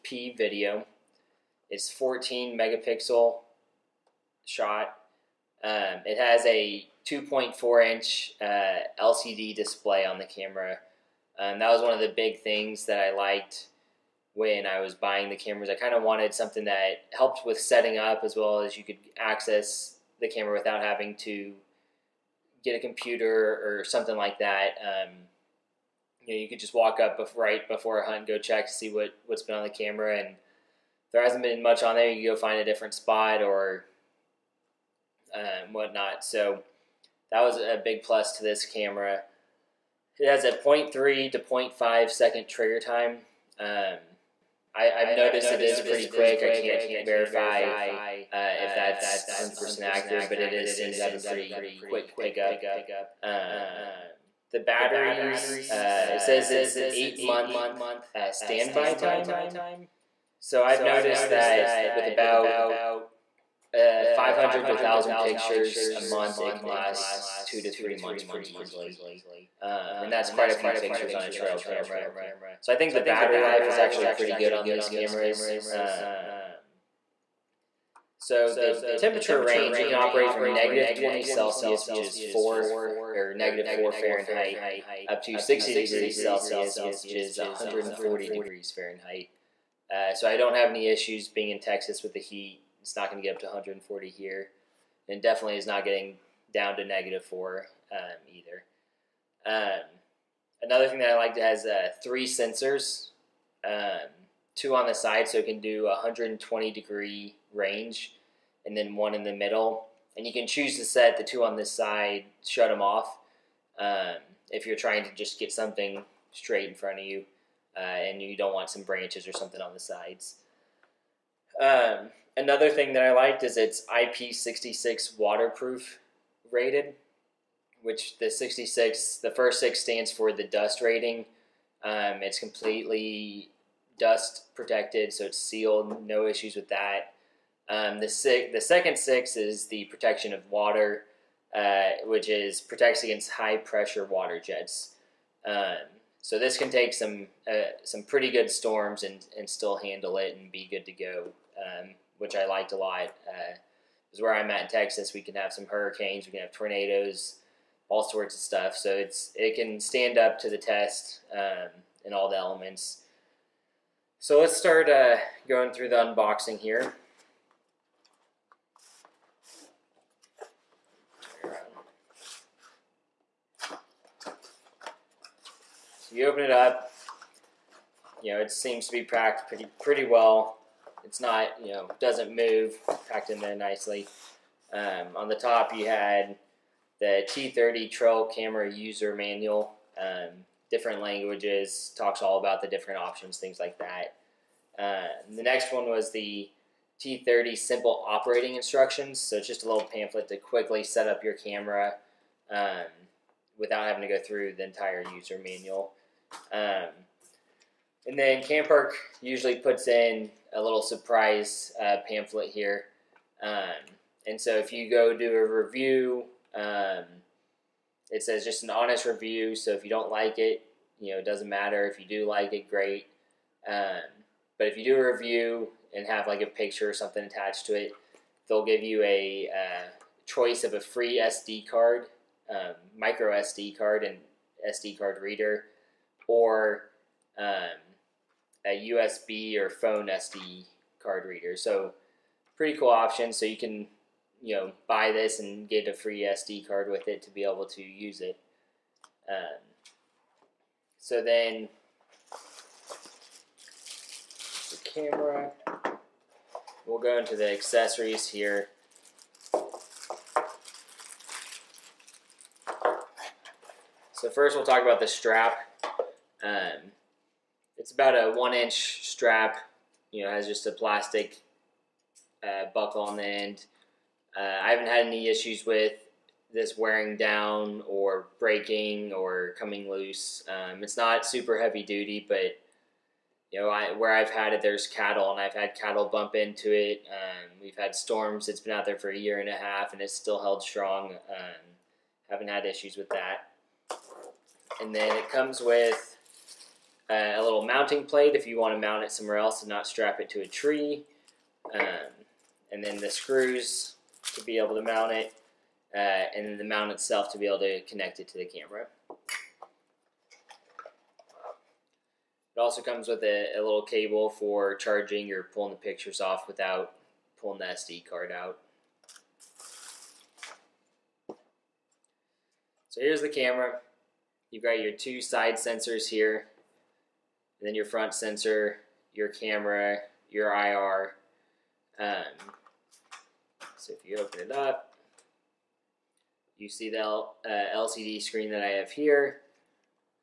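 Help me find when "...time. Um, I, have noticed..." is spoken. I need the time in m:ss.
0:42.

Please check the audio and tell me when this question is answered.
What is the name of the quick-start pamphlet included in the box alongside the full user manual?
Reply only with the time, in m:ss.
3:16.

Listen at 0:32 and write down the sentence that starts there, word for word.
You go find a different spot or um, whatnot.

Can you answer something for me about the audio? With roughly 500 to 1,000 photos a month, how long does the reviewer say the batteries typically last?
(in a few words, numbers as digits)
2 to 3 months.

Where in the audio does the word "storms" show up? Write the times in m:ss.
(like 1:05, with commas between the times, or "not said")
2:28, 4:47.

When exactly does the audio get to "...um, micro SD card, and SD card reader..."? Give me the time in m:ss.
3:52.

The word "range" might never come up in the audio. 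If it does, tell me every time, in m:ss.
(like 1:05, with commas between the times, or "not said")
1:19, 1:47.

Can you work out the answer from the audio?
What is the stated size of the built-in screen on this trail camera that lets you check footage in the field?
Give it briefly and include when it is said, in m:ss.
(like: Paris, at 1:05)
2.4 inch, at 0:07.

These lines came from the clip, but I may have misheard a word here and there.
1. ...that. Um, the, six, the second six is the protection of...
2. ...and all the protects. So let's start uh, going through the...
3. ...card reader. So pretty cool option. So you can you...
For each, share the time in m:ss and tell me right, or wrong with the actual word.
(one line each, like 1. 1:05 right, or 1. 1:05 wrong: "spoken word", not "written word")
1. 2:16 right
2. 2:42 wrong: "elements", not "protects"
3. 4:01 right.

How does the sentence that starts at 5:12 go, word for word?
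It also comes with a, a little cable for charging or pulling the pictures off without pulling the SD card out.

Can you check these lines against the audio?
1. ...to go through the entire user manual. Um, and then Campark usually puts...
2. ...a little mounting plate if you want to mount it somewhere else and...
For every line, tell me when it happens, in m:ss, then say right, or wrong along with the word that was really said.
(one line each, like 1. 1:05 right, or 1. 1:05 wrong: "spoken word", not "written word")
1. 3:24 right
2. 4:57 right.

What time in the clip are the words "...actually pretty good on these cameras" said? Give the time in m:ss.
1:13.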